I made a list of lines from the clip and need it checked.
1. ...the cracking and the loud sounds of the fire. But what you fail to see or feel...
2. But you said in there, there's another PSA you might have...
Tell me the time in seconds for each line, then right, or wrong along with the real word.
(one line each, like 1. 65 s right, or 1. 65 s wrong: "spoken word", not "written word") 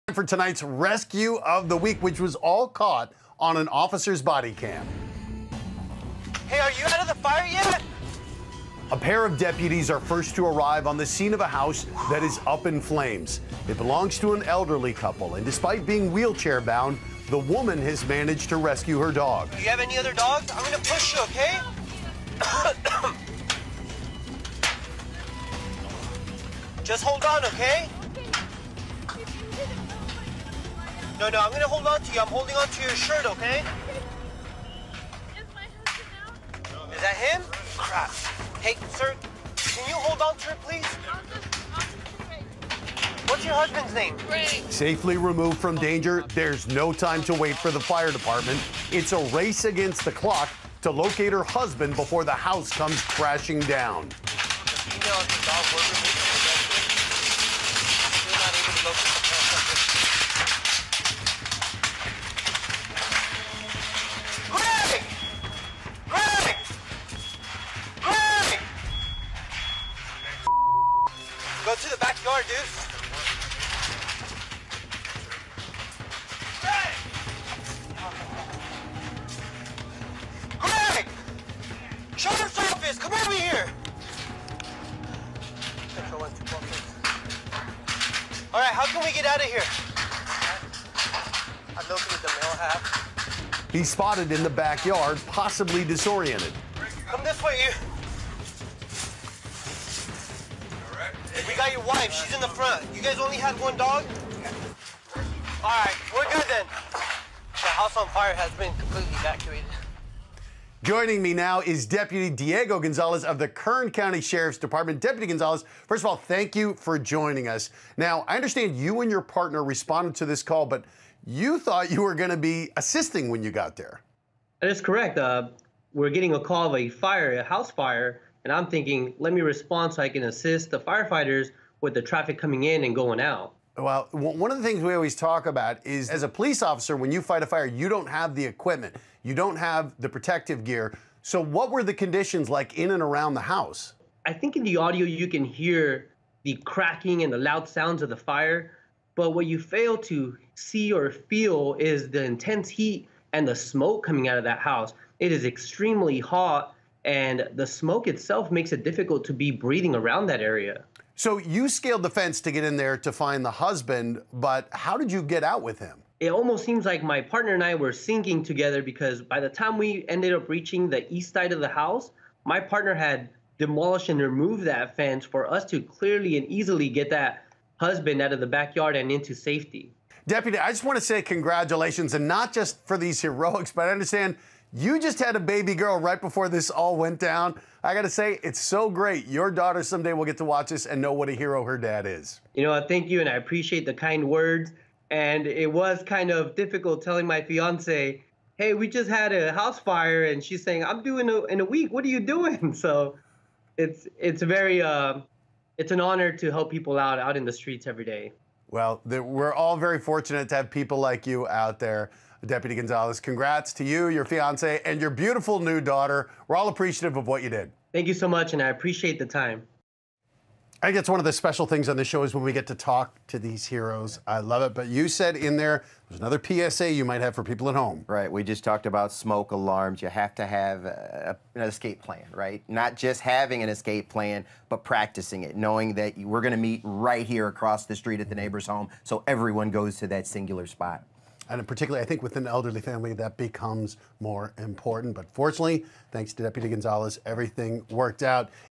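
1. 146 s right
2. 224 s right.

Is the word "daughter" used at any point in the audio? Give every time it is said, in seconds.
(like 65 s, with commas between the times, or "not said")
189 s, 215 s.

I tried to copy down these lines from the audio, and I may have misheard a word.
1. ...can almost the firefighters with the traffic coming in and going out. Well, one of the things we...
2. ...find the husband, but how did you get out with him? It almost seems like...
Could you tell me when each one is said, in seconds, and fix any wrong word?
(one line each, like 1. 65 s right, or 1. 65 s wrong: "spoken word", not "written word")
1. 130 s wrong: "assist", not "almost"
2. 163 s right.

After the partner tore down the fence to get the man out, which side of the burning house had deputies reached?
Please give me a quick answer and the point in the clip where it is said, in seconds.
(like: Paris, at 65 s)
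East side, at 171 s.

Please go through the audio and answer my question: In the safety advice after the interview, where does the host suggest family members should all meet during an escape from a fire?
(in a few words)
The neighbor's home.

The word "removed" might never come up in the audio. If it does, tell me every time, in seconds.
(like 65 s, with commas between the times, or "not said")
45 s, 174 s.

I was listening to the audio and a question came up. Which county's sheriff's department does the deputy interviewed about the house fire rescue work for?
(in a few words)
Kern County.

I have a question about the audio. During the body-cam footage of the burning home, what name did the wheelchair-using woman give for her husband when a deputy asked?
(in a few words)
Ray.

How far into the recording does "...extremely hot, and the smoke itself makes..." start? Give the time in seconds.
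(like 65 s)
155 s.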